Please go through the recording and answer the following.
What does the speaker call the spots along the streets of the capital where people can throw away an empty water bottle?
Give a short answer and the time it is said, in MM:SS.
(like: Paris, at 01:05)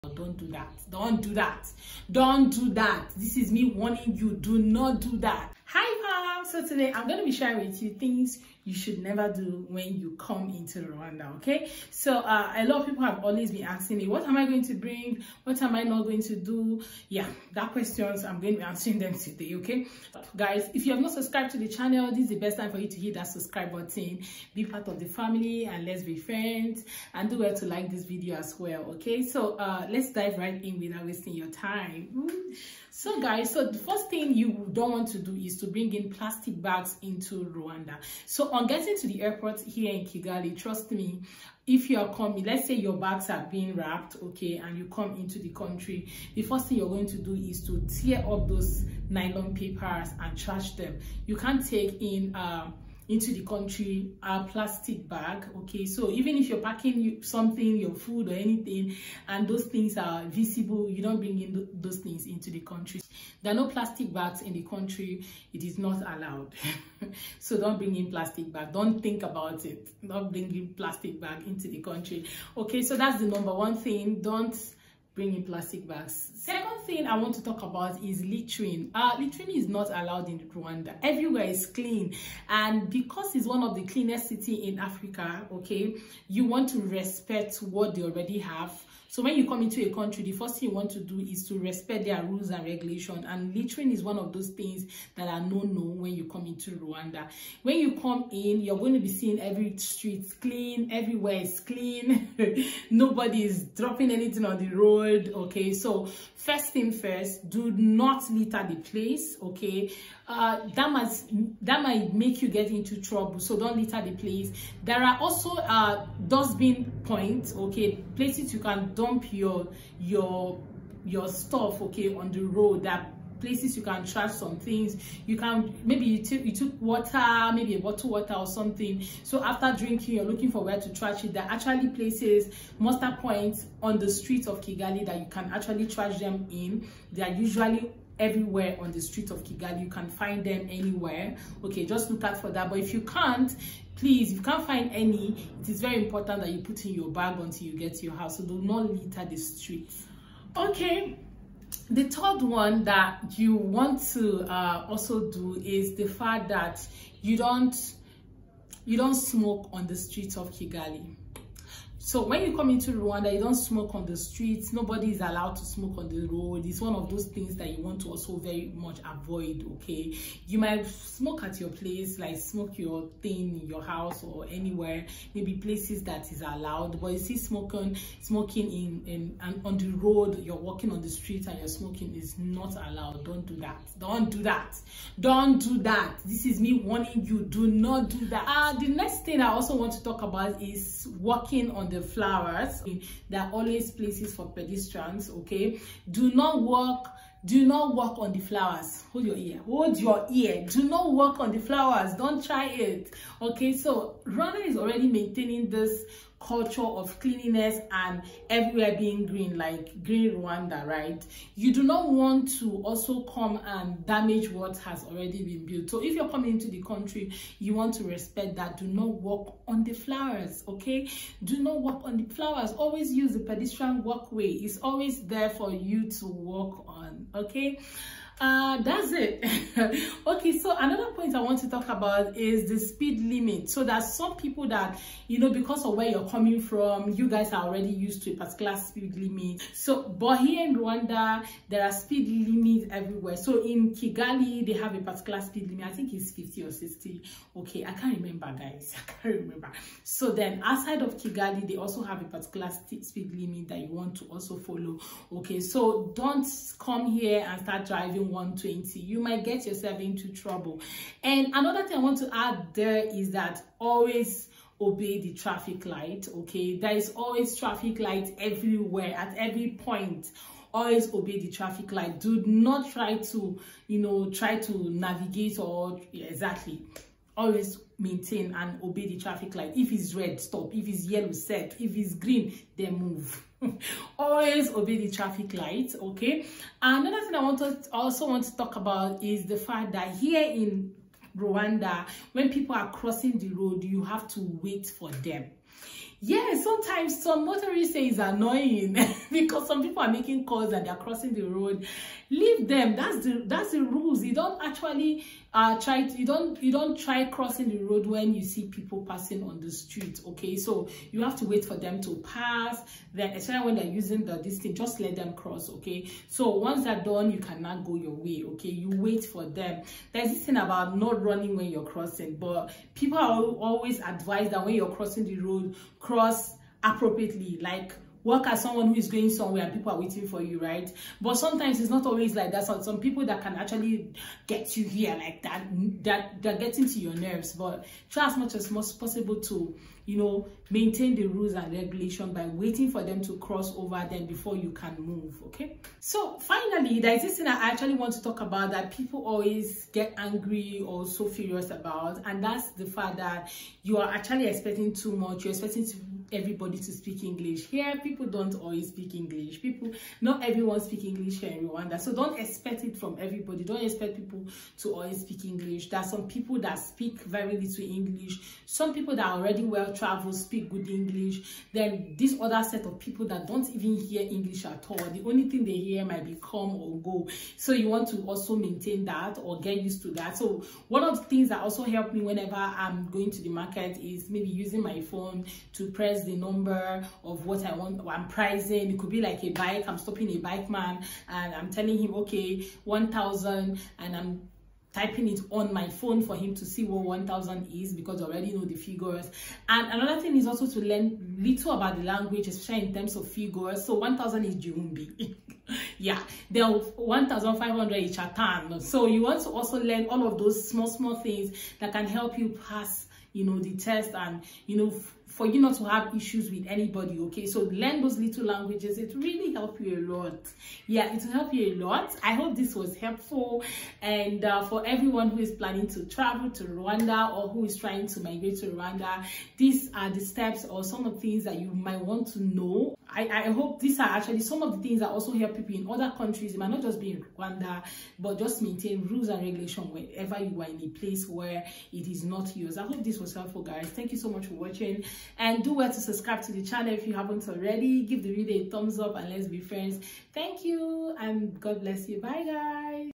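muster points, at 02:12.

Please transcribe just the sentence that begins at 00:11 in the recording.
So uh, a lot of people have always been asking me, what am I going to bring?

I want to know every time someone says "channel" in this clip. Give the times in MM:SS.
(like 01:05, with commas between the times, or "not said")
00:21, 07:26.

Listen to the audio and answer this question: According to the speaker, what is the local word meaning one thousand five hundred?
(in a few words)
Chatan.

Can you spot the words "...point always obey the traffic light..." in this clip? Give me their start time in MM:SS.
04:29.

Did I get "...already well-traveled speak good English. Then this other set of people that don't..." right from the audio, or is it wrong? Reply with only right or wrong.
right.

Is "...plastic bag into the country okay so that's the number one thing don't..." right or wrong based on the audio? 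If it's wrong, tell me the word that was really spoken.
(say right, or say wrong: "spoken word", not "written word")
right.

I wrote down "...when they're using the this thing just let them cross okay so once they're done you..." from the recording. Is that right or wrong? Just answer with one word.
right.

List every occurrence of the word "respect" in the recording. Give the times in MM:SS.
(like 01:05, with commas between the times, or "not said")
01:26, 01:31, 03:38.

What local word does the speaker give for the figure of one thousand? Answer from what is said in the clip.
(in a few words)
Jumbi.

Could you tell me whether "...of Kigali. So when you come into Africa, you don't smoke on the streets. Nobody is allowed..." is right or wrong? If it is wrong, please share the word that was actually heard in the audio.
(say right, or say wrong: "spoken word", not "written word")
wrong: "Rwanda", not "Africa".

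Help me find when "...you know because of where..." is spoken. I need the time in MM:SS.
03:55.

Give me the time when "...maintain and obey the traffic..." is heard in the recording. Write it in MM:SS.
04:37.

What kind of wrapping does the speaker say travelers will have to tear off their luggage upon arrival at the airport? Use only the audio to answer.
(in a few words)
nylon papers.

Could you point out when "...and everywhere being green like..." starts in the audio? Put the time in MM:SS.
03:27.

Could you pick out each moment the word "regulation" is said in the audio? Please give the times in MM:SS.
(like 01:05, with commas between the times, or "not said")
01:32, 05:41, 07:19.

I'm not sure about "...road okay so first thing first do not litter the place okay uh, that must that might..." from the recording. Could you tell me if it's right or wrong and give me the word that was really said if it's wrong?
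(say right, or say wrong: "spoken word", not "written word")
right.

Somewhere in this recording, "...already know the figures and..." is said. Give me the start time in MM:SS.
06:38.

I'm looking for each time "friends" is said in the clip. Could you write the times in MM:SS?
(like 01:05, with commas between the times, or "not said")
00:26, 07:29.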